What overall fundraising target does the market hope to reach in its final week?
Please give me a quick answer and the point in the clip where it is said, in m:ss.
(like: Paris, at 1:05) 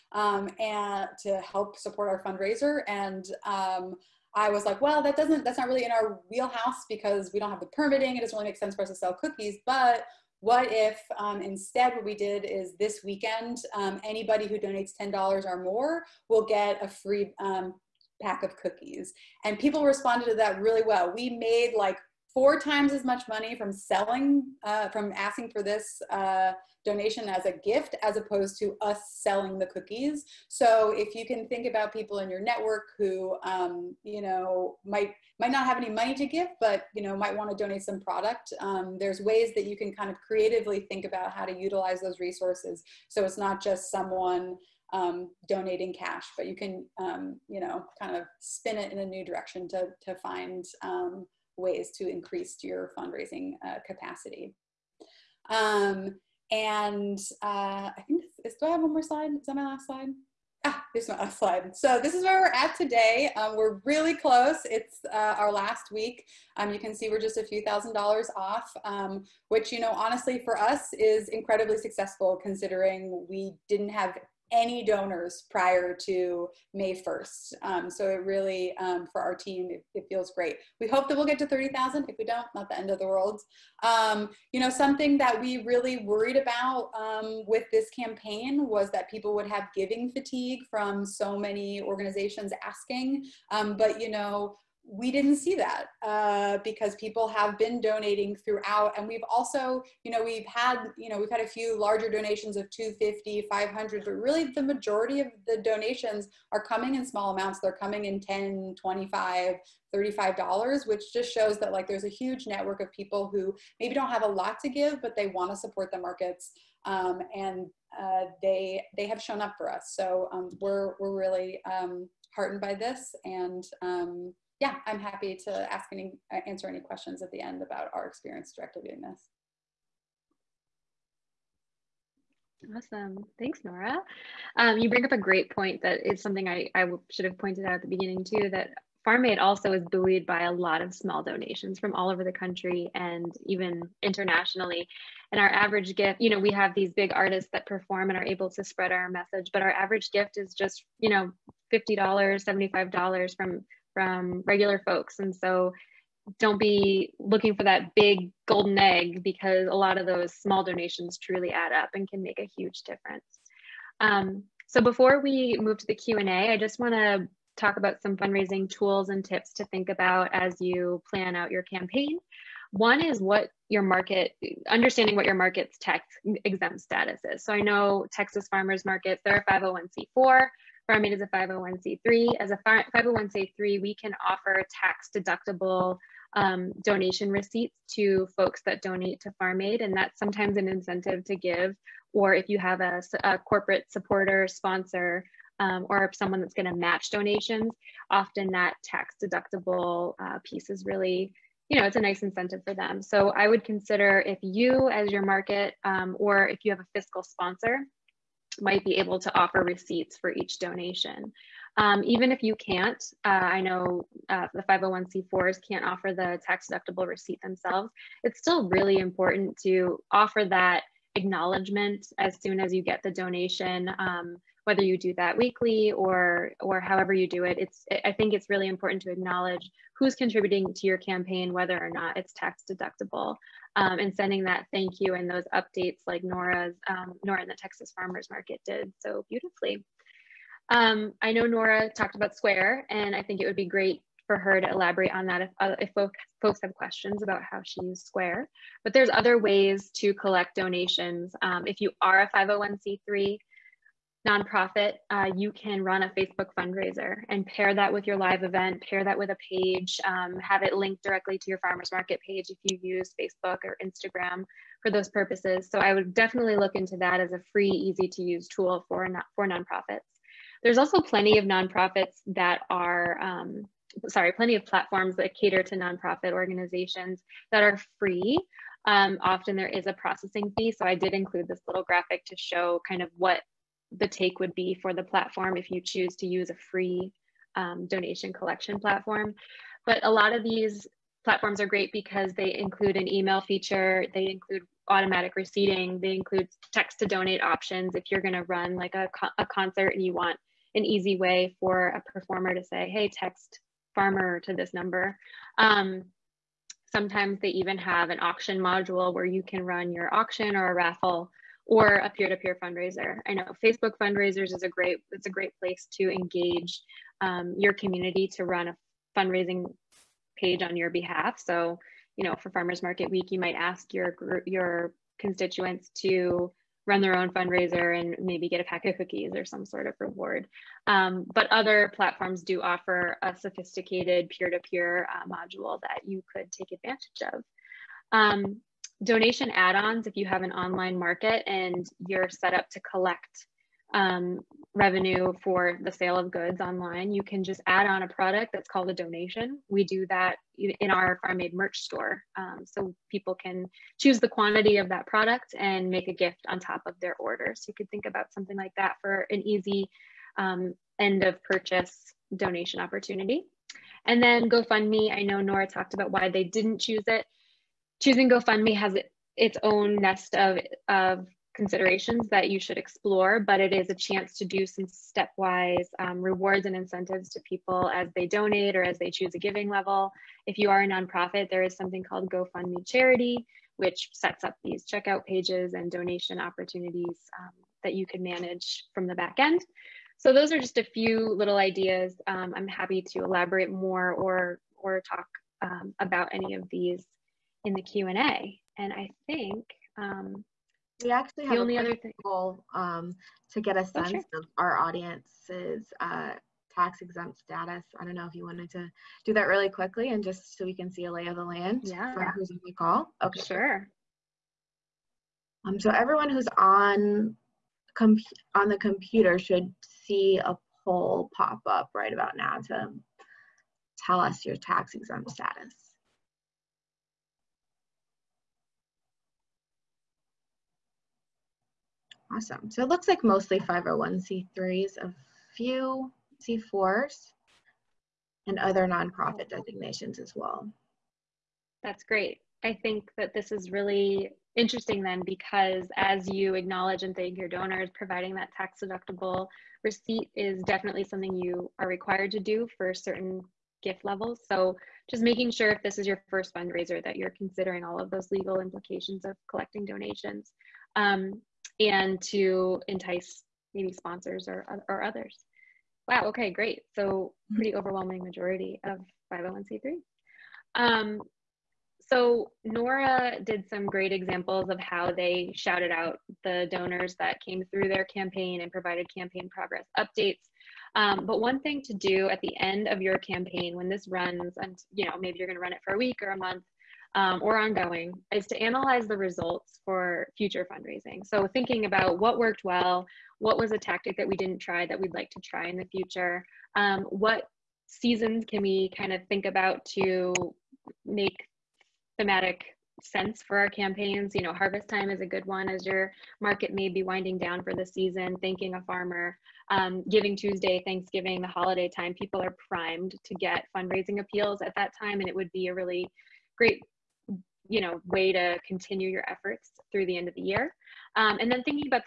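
30,000, at 1:21.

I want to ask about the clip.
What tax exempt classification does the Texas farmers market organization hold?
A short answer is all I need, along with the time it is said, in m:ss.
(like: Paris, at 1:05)
501c4, at 2:59.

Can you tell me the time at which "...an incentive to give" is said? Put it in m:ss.
3:10.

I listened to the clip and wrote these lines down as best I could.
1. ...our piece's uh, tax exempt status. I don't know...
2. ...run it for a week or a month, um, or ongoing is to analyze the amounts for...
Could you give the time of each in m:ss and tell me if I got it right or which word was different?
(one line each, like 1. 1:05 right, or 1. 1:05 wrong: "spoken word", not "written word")
1. 6:44 wrong: "audience", not "piece"
2. 8:05 wrong: "results", not "amounts".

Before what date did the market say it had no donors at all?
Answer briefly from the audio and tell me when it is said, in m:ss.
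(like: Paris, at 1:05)
May 1st, at 1:16.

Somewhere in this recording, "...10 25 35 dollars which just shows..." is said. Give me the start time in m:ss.
1:48.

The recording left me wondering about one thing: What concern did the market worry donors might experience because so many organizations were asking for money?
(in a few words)
giving fatigue.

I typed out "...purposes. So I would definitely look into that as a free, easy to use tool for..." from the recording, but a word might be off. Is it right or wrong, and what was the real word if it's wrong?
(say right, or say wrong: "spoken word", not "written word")
right.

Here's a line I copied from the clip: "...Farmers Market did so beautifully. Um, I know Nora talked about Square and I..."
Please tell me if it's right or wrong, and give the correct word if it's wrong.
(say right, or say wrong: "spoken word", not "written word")
right.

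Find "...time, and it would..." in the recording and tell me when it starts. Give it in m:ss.
8:35.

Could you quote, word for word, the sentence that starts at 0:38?
Um, there's ways that you can kind of creatively think about how to utilize those resources.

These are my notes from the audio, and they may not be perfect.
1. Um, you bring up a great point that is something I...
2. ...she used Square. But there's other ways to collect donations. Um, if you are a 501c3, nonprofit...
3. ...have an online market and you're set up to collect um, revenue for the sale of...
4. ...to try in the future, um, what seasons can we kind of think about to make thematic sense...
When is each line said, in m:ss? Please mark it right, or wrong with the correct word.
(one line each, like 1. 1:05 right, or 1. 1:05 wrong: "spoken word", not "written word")
1. 2:14 right
2. 4:07 right
3. 5:40 right
4. 8:15 right.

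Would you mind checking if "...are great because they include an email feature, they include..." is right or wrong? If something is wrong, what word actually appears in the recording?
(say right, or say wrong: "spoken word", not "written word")
right.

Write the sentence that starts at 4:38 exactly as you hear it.
Um, often there is a processing fee.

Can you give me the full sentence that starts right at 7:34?
So just making sure if this is your first fundraiser that you're considering all of those legal implications of collecting donations.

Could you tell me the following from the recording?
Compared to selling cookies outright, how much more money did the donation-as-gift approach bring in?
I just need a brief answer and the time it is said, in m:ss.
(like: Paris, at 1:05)
four times, at 0:22.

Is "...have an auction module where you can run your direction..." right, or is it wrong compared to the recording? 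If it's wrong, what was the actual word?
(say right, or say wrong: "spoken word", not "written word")
wrong: "auction", not "direction".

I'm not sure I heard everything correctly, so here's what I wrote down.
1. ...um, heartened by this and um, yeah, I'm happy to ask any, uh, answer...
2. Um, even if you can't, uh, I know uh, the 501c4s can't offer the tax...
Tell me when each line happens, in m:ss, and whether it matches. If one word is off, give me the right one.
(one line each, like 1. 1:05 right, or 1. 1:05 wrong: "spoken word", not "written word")
1. 2:01 right
2. 3:31 right.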